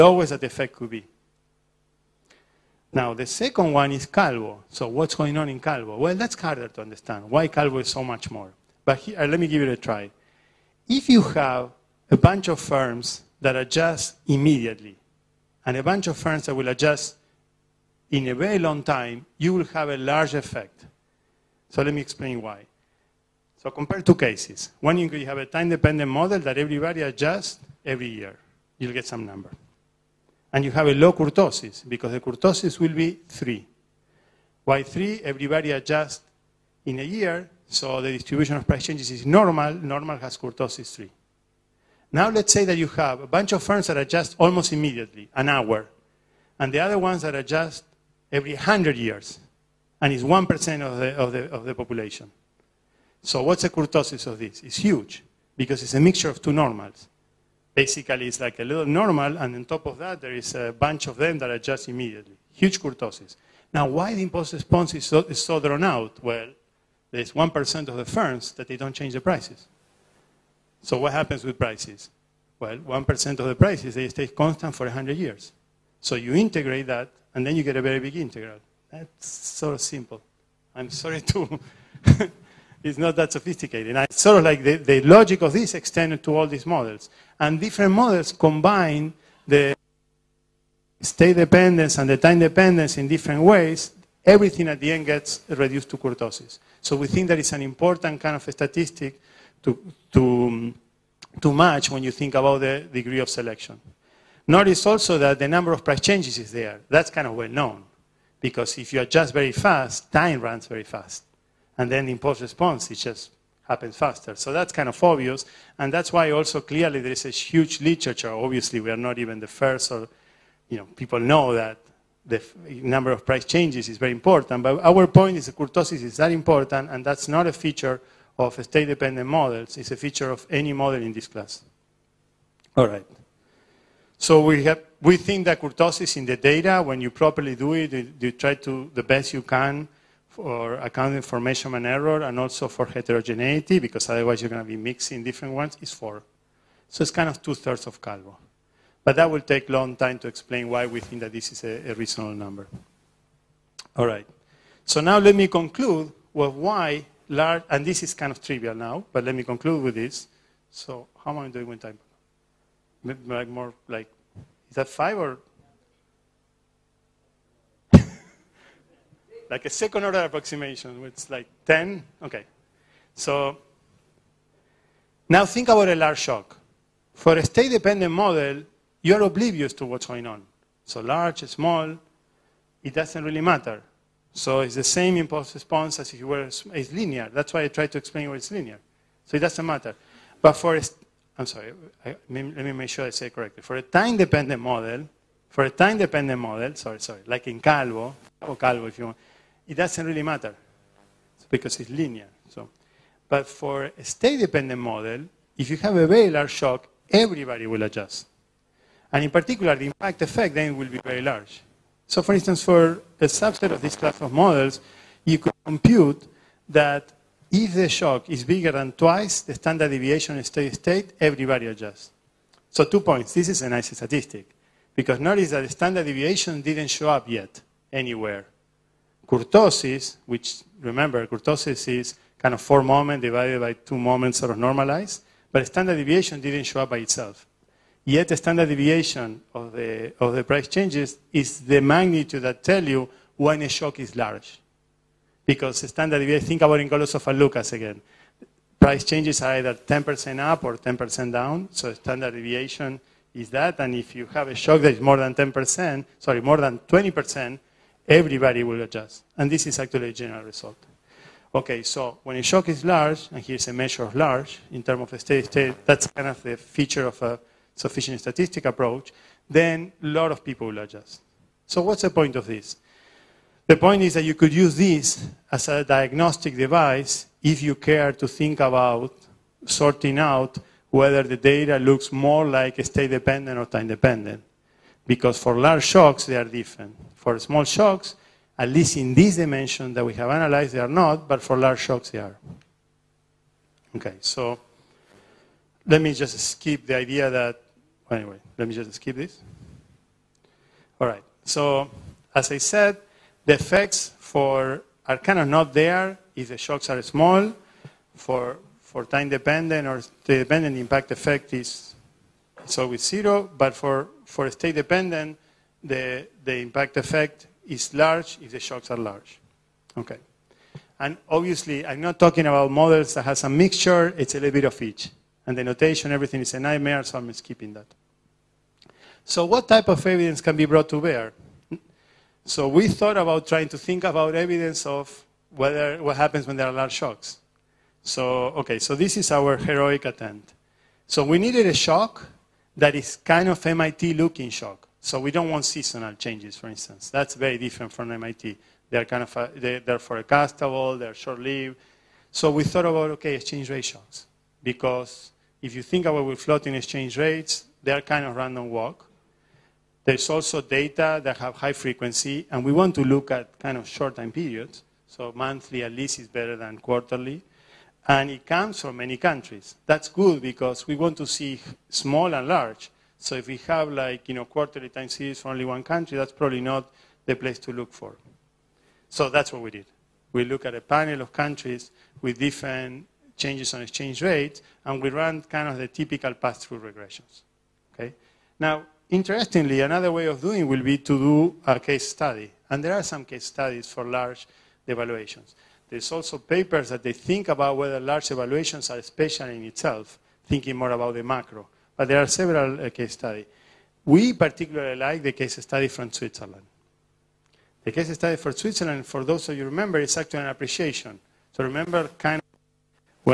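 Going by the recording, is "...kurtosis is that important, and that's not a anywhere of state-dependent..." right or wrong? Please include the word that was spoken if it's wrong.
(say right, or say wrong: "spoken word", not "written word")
wrong: "feature", not "anywhere".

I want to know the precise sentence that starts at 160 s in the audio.
So how am I doing with time?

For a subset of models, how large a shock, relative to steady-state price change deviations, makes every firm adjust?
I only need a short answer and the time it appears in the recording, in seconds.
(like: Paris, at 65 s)
twice, at 218 s.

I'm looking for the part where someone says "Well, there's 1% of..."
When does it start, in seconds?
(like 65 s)
66 s.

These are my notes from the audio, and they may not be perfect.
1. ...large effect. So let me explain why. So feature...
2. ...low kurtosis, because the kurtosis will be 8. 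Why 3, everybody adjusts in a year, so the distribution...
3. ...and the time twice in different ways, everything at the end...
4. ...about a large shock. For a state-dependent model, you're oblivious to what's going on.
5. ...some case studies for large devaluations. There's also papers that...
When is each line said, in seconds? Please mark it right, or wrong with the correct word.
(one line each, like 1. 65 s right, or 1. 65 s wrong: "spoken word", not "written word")
1. 19 s wrong: "compare", not "feature"
2. 30 s wrong: "3", not "8"
3. 91 s wrong: "dependence", not "twice"
4. 175 s right
5. 393 s right.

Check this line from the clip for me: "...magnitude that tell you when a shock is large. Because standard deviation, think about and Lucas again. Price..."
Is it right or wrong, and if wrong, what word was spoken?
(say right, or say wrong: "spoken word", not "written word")
right.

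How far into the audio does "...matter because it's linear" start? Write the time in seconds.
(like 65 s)
200 s.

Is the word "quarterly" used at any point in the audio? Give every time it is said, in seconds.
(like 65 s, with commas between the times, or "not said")
366 s, 374 s.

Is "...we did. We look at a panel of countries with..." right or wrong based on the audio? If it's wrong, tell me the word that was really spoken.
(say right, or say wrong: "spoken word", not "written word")
right.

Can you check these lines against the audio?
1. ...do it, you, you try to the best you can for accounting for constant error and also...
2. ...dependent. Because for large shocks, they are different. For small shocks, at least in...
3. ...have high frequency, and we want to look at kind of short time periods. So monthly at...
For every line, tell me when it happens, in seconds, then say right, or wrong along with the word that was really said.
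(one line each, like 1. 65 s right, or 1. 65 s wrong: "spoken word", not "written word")
1. 137 s wrong: "measurement", not "constant"
2. 283 s right
3. 361 s right.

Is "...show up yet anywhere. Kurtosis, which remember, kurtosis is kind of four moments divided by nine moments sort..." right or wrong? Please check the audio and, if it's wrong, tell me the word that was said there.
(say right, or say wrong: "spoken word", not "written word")
wrong: "two", not "nine".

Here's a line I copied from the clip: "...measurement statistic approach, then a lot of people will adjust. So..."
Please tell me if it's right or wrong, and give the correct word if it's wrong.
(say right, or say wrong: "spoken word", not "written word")
wrong: "sufficient", not "measurement".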